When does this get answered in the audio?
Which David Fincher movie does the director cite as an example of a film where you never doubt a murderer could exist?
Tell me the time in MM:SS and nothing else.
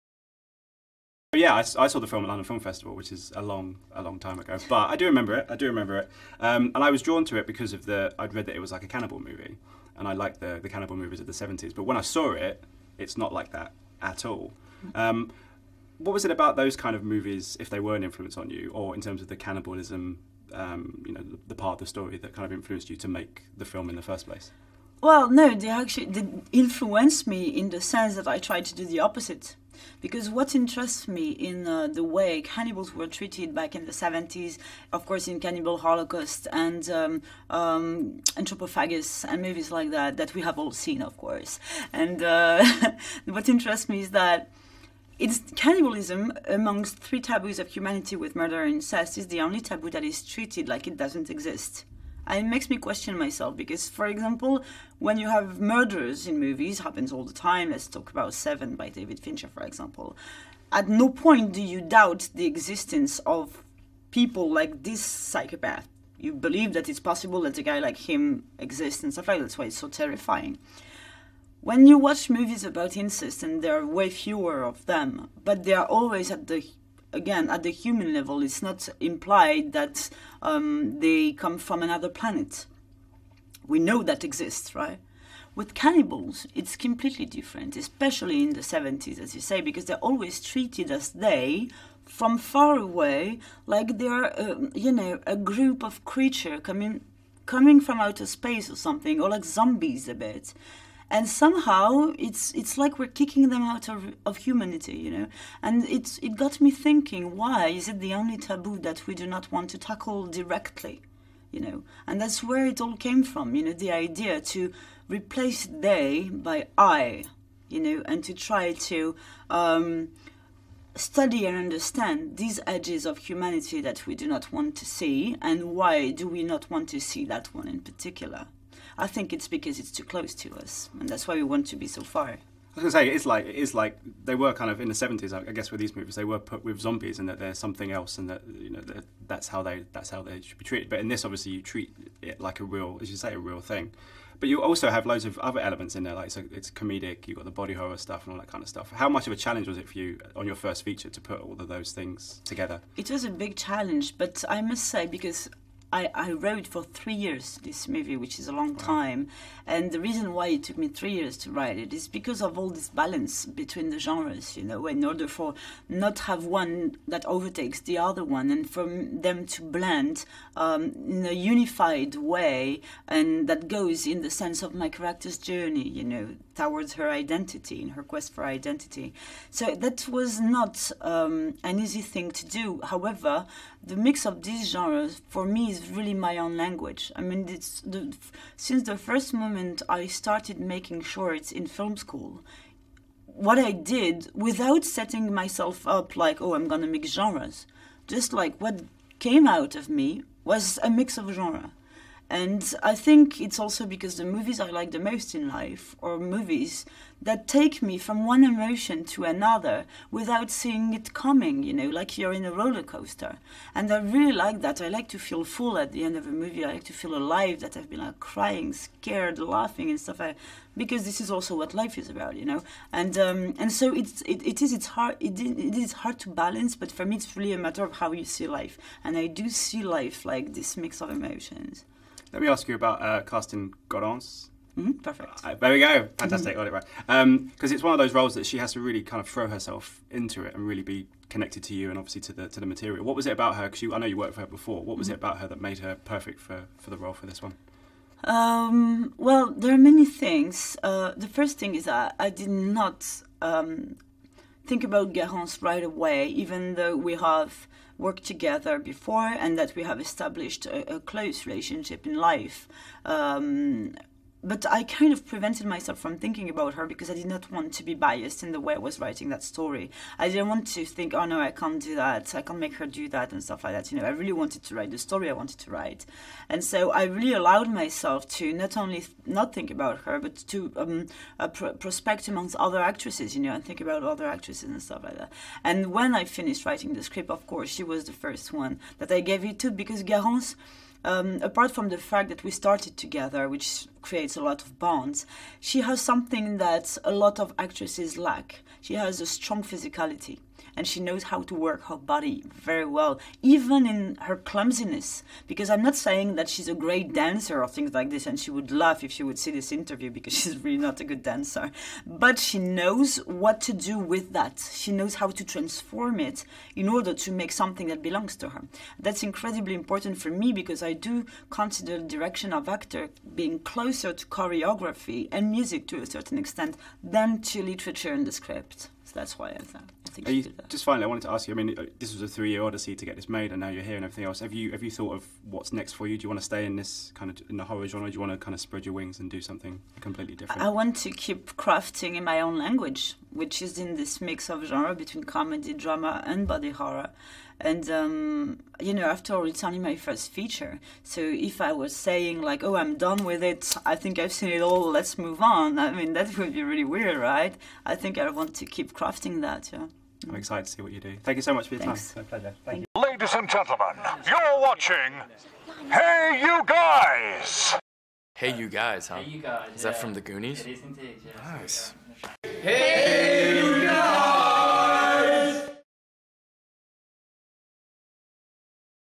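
00:58.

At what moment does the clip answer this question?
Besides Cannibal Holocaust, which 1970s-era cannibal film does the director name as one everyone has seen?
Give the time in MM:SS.
00:38.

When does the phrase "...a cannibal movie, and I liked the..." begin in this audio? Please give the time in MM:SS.
00:08.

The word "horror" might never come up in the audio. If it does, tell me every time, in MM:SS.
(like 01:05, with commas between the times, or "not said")
02:27, 05:37, 05:46.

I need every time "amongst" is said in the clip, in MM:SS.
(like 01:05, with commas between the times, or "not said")
00:46, 04:42.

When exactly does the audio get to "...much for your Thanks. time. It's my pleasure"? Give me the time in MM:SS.
06:01.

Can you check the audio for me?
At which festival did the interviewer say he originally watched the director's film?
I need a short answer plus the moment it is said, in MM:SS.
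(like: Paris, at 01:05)
London Film Festival, at 00:02.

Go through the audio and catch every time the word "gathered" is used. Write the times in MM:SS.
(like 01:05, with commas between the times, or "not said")
not said.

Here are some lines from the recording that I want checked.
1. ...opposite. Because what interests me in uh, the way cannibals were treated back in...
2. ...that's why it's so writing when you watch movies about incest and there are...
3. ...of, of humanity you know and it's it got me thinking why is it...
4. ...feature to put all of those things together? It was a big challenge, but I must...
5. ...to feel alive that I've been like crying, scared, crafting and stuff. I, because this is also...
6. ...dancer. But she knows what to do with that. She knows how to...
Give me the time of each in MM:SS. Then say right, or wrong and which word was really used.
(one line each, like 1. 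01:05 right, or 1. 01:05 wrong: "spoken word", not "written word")
1. 00:28 right
2. 01:09 wrong: "terrifying", not "writing"
3. 01:43 right
4. 02:30 right
5. 03:36 wrong: "laughing", not "crafting"
6. 05:11 right.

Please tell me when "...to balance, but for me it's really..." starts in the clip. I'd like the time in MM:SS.
03:46.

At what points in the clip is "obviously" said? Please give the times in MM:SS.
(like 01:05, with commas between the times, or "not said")
02:21, 04:01.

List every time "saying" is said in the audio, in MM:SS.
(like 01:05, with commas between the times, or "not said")
05:05, 05:51.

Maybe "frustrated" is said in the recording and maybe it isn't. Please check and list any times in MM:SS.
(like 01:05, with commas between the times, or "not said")
not said.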